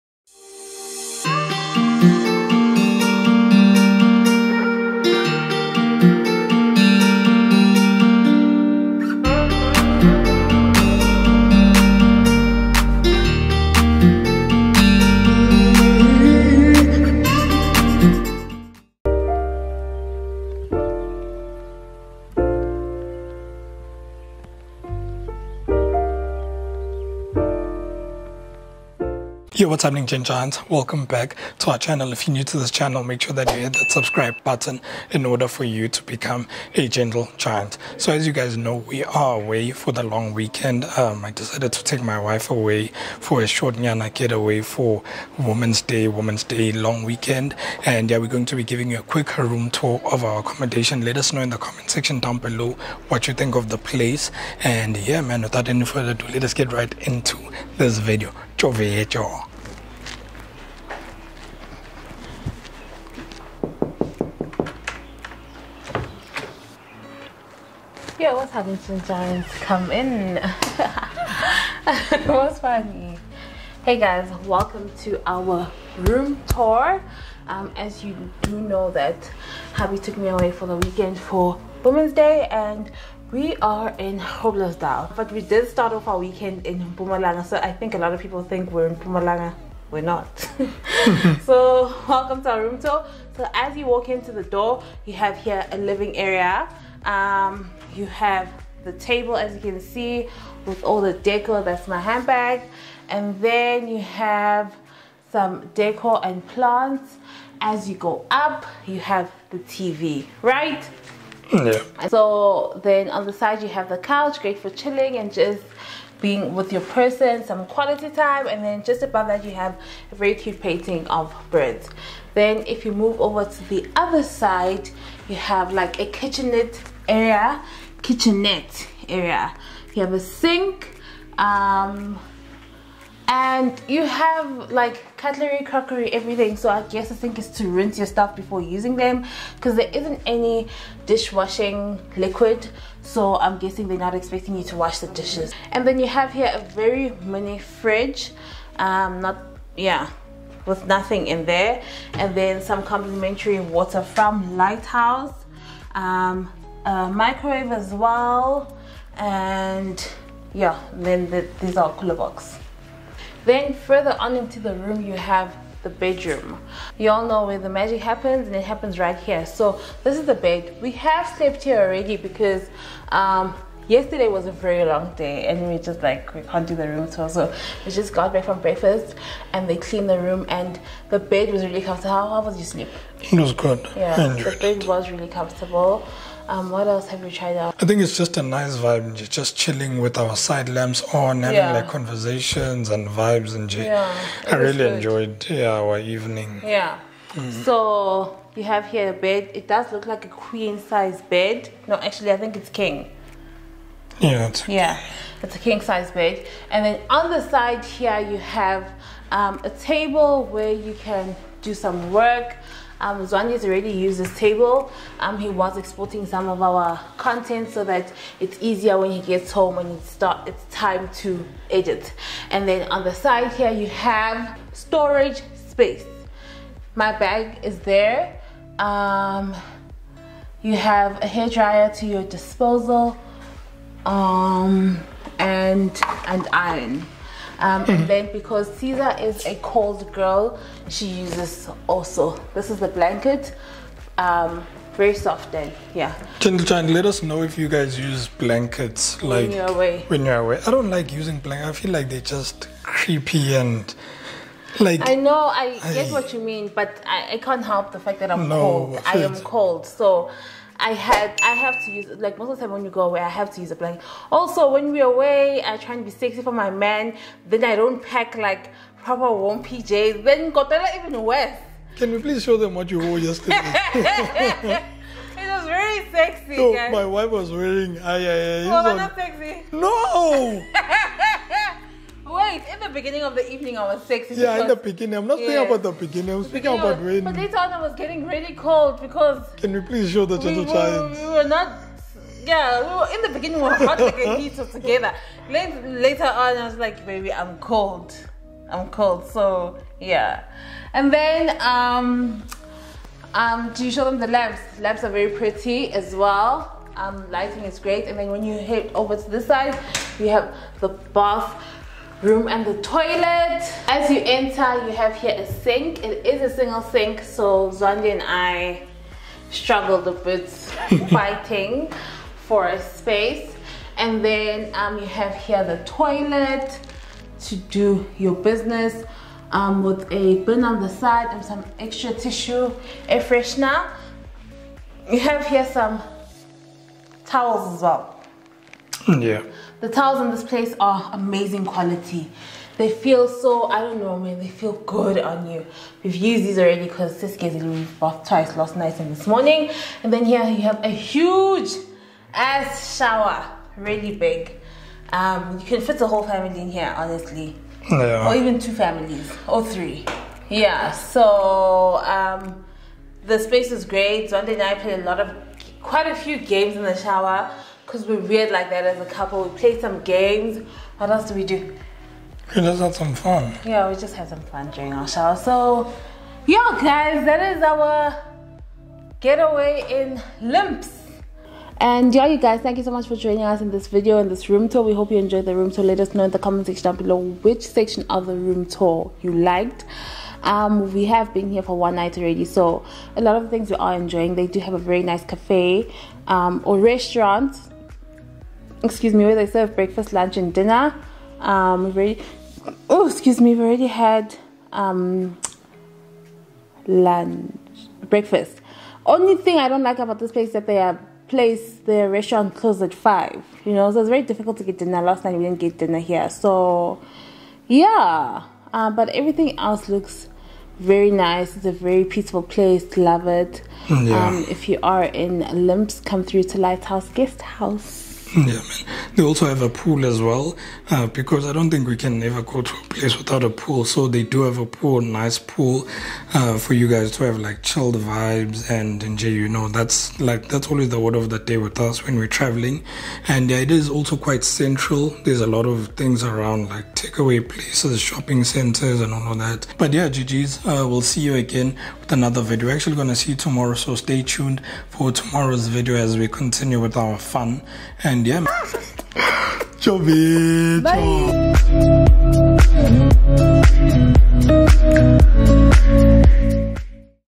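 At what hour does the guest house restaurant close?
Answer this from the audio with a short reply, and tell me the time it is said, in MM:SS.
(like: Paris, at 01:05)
5, at 06:52.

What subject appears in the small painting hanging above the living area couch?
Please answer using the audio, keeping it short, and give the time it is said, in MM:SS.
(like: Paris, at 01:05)
Birds, at 02:01.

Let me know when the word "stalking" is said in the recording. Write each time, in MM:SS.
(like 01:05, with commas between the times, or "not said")
not said.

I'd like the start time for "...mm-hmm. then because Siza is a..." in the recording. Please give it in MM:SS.
03:57.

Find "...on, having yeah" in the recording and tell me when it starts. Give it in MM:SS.
03:11.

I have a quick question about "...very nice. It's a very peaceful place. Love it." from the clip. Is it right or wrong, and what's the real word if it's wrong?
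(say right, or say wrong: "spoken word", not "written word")
right.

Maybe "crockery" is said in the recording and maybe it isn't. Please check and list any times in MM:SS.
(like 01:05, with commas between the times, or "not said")
02:15.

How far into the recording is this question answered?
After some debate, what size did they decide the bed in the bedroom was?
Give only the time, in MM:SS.
03:25.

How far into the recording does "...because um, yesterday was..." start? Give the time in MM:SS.
02:52.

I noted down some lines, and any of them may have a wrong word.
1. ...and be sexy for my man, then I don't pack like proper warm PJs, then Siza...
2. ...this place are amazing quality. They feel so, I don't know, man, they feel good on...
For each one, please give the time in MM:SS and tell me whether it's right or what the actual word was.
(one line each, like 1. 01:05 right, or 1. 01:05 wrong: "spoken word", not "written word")
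1. 04:25 wrong: "Kotela", not "Siza"
2. 05:40 right.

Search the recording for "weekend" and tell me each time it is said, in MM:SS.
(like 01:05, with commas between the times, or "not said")
00:40, 00:47, 01:20, 01:26.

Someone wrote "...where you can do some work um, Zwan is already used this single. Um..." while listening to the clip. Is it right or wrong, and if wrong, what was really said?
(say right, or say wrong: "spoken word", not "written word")
wrong: "table", not "single".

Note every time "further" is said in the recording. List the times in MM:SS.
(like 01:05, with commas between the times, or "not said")
00:55, 02:43.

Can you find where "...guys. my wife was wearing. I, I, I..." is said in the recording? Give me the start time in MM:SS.
04:36.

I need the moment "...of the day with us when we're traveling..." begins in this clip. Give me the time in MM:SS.
07:21.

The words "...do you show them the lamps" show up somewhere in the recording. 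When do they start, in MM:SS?
05:03.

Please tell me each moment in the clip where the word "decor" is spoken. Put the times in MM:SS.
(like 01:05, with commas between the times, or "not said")
01:41, 01:45.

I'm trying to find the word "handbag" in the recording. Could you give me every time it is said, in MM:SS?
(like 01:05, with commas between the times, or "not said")
01:41.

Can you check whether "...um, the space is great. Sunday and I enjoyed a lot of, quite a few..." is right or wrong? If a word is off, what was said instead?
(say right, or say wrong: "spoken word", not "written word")
wrong: "played", not "enjoyed".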